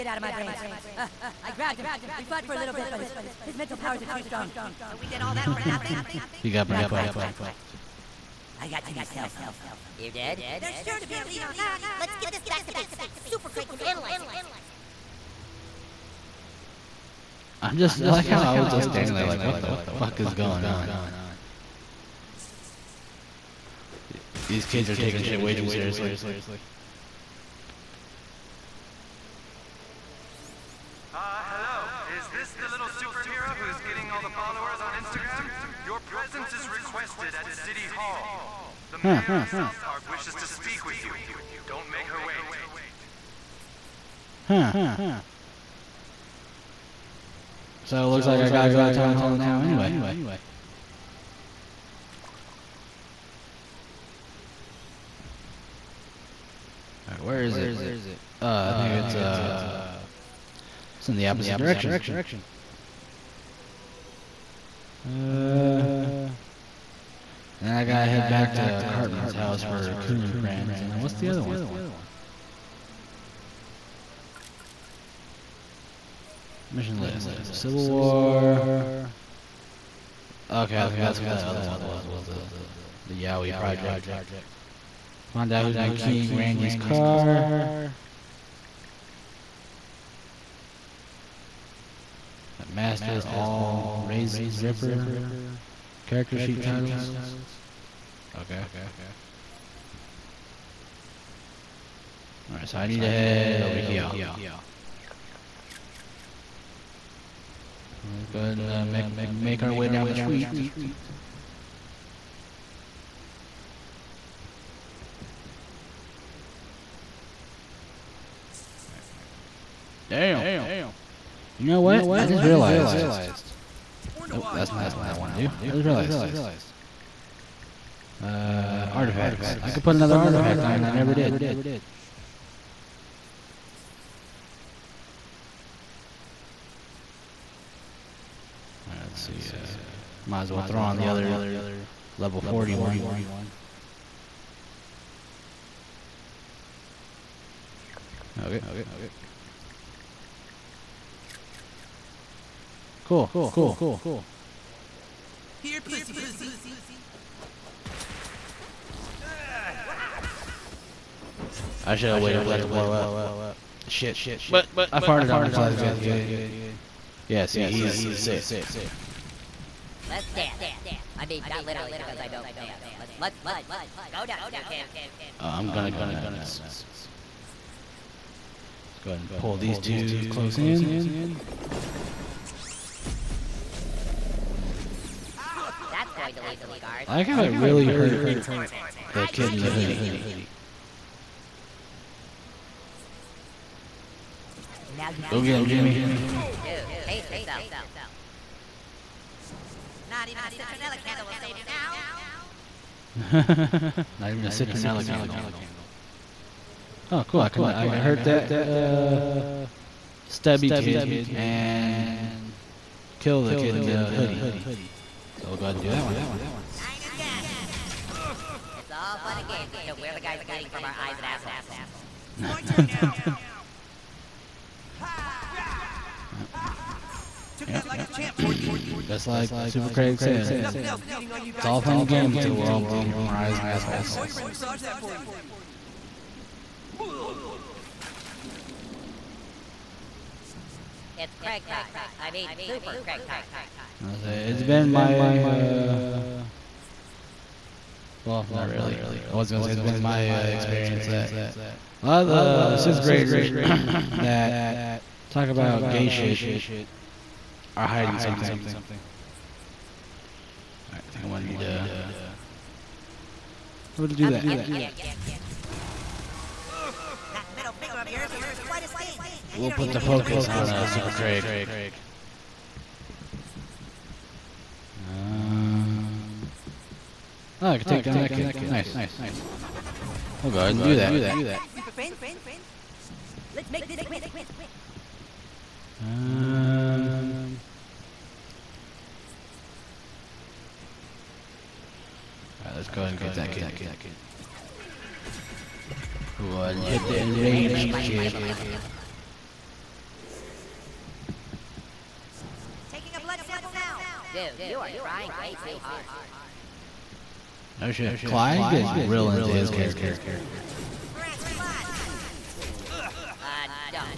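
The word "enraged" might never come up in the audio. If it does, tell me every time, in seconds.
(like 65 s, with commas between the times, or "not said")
297 s.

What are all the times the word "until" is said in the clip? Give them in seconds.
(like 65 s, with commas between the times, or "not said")
219 s, 232 s.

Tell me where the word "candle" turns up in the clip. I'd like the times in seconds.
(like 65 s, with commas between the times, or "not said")
201 s, 205 s.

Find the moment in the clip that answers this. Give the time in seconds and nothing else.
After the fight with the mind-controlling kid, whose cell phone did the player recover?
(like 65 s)
8 s.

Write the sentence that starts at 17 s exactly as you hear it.
I'm just, I like how I was just standing there like, what the fuck is going on?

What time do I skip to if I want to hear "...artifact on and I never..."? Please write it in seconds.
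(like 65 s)
130 s.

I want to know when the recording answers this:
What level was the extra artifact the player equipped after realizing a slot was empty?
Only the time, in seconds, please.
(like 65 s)
142 s.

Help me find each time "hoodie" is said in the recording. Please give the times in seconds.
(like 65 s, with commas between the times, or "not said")
189 s, 214 s.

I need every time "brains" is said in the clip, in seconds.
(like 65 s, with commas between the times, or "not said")
0 s, 6 s.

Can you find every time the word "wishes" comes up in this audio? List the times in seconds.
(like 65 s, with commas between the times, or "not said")
40 s.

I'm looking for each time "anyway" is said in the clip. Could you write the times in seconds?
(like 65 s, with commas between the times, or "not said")
49 s.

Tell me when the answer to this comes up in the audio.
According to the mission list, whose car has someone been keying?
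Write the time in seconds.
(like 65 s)
86 s.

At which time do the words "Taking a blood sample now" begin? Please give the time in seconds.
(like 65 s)
302 s.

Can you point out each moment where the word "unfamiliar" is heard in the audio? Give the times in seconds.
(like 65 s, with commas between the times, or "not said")
not said.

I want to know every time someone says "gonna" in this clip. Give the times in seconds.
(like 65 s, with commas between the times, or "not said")
175 s, 249 s, 264 s.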